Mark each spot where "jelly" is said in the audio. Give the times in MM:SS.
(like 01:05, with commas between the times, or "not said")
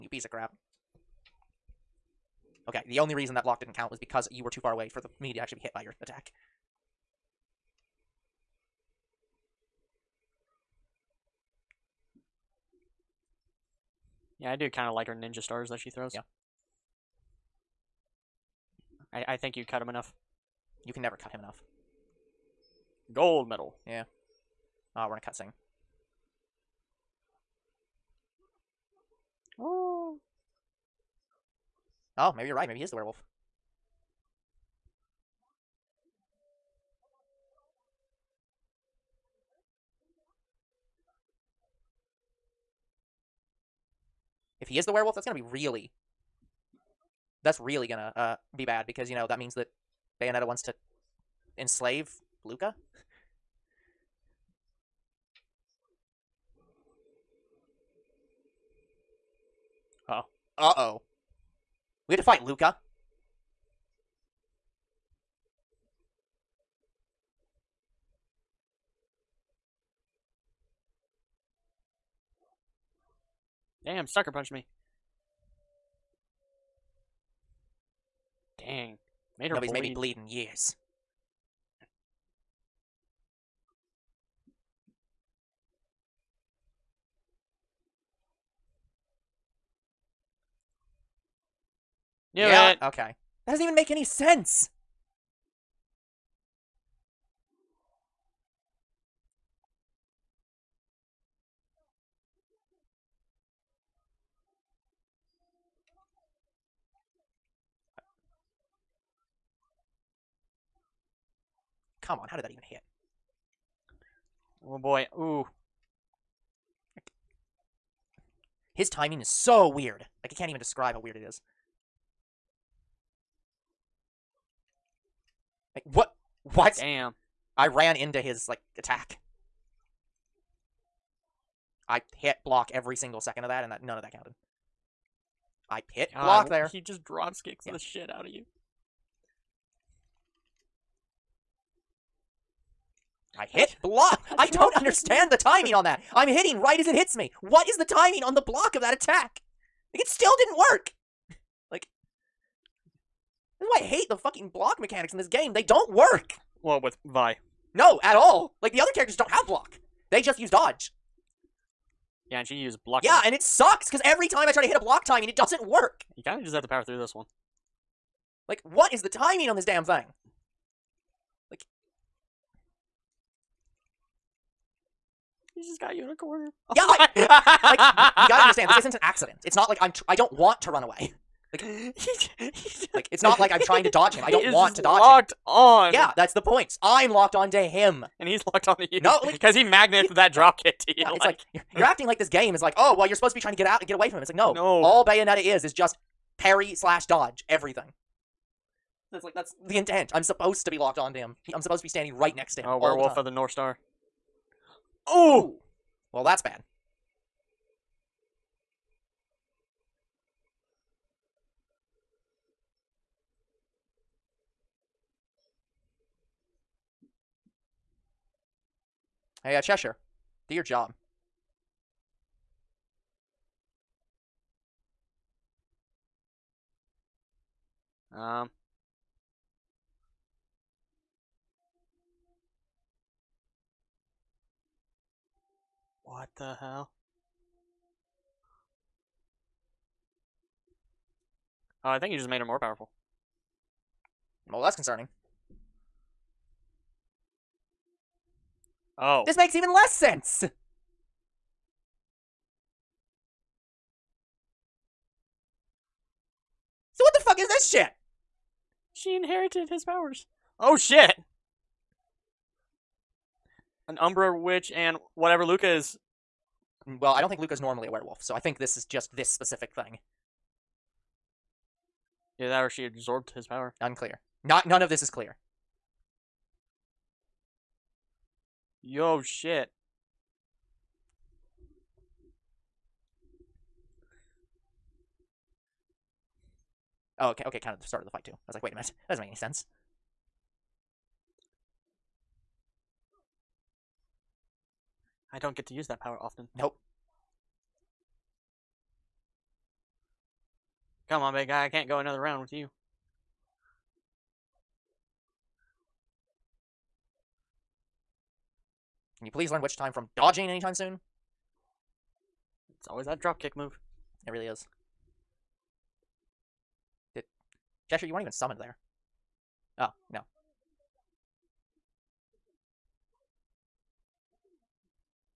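not said.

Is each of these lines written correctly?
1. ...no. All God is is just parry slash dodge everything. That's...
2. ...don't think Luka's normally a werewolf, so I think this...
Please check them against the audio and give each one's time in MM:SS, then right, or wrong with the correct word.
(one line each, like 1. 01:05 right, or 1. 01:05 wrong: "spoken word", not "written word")
1. 03:14 wrong: "Bayonetta", not "God"
2. 04:27 right.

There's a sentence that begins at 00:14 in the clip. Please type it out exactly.
Yeah, I do kind of like her ninja stars that she throws.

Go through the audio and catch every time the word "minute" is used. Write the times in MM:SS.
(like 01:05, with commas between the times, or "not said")
04:48.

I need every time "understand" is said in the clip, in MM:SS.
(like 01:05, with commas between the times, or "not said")
02:24, 02:58.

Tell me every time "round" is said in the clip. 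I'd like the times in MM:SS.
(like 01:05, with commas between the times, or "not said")
05:02.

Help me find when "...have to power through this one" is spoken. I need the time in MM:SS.
02:46.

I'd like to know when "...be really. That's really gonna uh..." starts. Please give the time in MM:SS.
00:45.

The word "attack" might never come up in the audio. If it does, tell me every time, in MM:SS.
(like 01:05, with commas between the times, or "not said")
00:05, 02:08, 02:28.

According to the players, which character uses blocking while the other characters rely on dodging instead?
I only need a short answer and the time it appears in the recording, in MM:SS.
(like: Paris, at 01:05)
Vi, at 02:37.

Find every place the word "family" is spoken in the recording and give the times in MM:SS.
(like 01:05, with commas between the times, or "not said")
not said.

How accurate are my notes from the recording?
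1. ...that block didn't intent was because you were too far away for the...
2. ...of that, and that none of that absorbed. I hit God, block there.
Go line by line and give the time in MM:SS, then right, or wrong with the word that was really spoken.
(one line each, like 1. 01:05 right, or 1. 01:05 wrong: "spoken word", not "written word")
1. 00:03 wrong: "count", not "intent"
2. 02:13 wrong: "counted", not "absorbed".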